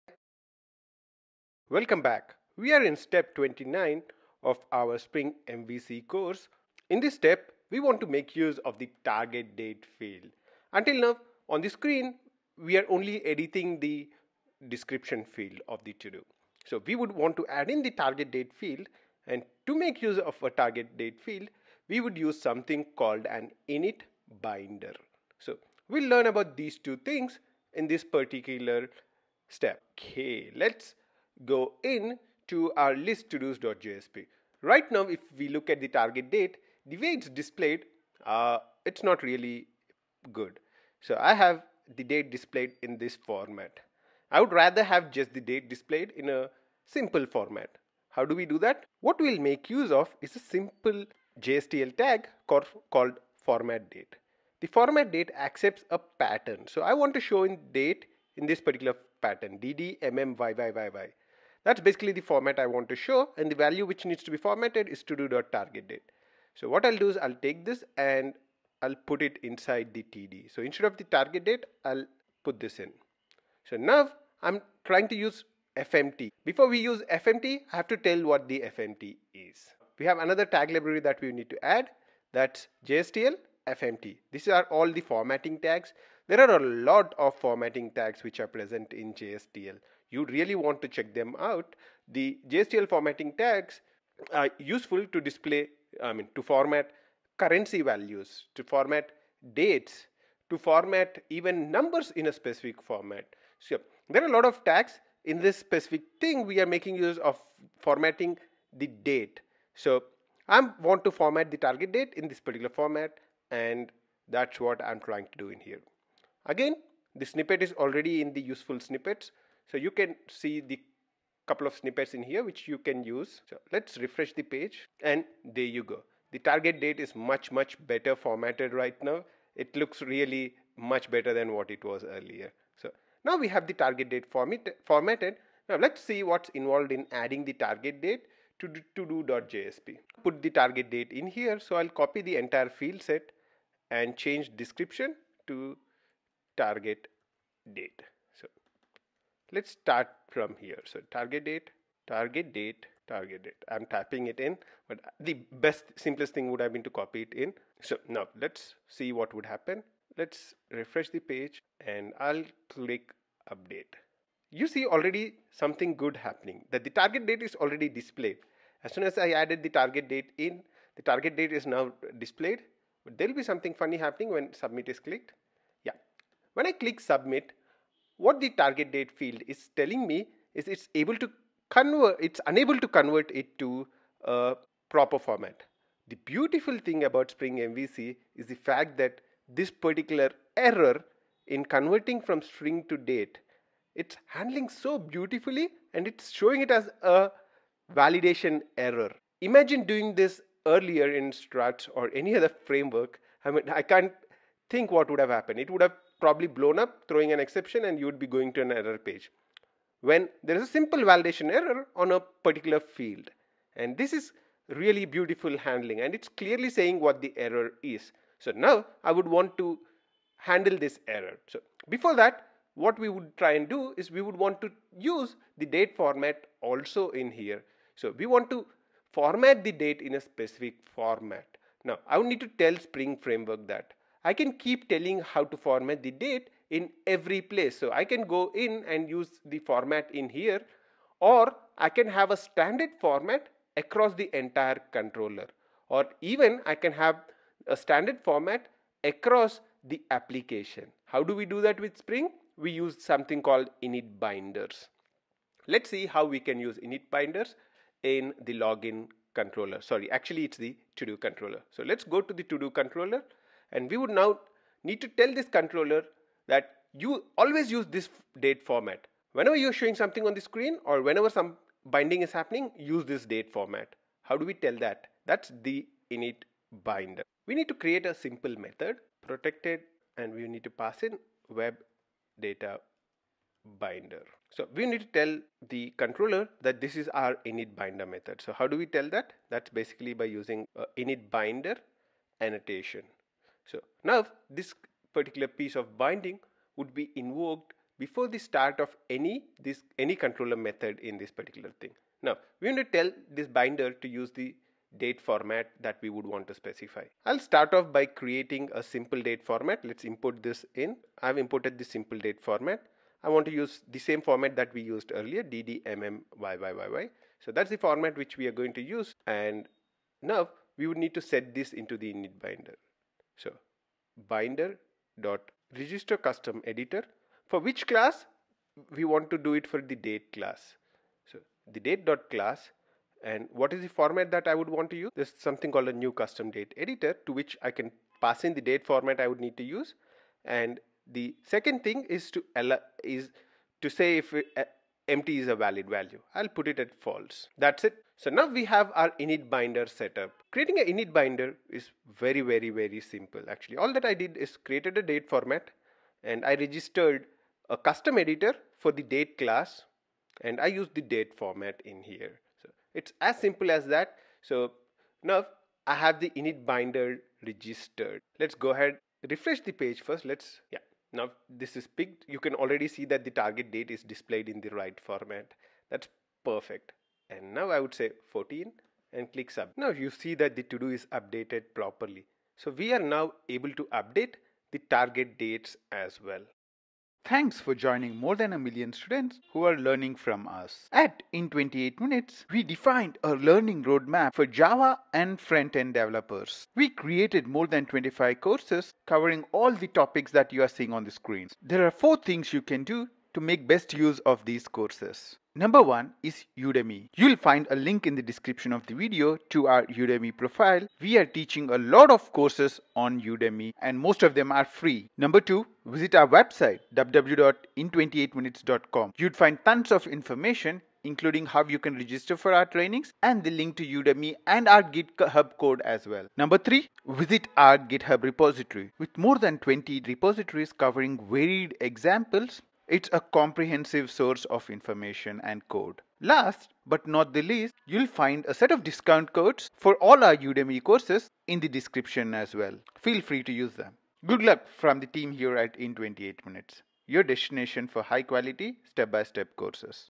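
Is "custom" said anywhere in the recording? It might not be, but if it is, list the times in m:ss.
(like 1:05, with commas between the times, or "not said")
5:26, 5:36, 5:57.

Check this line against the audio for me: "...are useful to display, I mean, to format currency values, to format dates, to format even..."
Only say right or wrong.
right.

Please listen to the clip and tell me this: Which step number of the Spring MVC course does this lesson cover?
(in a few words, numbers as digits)
29.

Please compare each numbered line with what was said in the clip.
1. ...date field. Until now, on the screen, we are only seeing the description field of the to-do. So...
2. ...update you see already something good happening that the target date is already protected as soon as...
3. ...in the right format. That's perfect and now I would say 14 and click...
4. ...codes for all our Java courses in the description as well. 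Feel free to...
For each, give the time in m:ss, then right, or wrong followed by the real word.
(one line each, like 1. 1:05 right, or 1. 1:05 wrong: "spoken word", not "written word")
1. 0:09 wrong: "editing", not "seeing"
2. 2:43 wrong: "displayed", not "protected"
3. 6:14 right
4. 7:19 wrong: "Udemy", not "Java".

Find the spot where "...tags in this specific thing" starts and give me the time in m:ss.
1:44.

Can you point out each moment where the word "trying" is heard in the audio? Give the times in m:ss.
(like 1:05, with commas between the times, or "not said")
1:14, 1:54.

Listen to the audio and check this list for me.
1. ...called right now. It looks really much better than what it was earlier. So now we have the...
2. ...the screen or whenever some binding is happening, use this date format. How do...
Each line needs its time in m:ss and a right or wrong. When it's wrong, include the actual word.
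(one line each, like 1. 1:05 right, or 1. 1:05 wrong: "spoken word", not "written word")
1. 2:08 wrong: "formatted", not "called"
2. 4:30 right.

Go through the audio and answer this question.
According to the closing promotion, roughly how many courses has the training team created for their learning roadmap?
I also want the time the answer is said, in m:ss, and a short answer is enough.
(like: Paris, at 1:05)
more than 25, at 6:37.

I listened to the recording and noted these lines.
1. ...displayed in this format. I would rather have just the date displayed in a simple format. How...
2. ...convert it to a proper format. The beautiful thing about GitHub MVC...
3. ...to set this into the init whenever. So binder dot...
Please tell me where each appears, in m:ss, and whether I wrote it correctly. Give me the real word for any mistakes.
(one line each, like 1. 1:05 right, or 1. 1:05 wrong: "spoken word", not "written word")
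1. 0:42 right
2. 3:02 wrong: "Spring", not "GitHub"
3. 5:21 wrong: "binder", not "whenever".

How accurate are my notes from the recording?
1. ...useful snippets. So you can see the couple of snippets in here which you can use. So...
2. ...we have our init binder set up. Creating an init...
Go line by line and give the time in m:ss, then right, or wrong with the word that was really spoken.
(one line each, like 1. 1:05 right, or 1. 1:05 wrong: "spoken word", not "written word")
1. 1:58 right
2. 5:48 right.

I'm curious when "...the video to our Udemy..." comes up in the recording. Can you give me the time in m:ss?
6:48.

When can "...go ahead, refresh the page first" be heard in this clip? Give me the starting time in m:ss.
6:08.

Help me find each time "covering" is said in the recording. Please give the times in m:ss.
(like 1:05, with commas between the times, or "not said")
6:39, 7:10.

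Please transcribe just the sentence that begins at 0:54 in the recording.
The format date accepts a pattern.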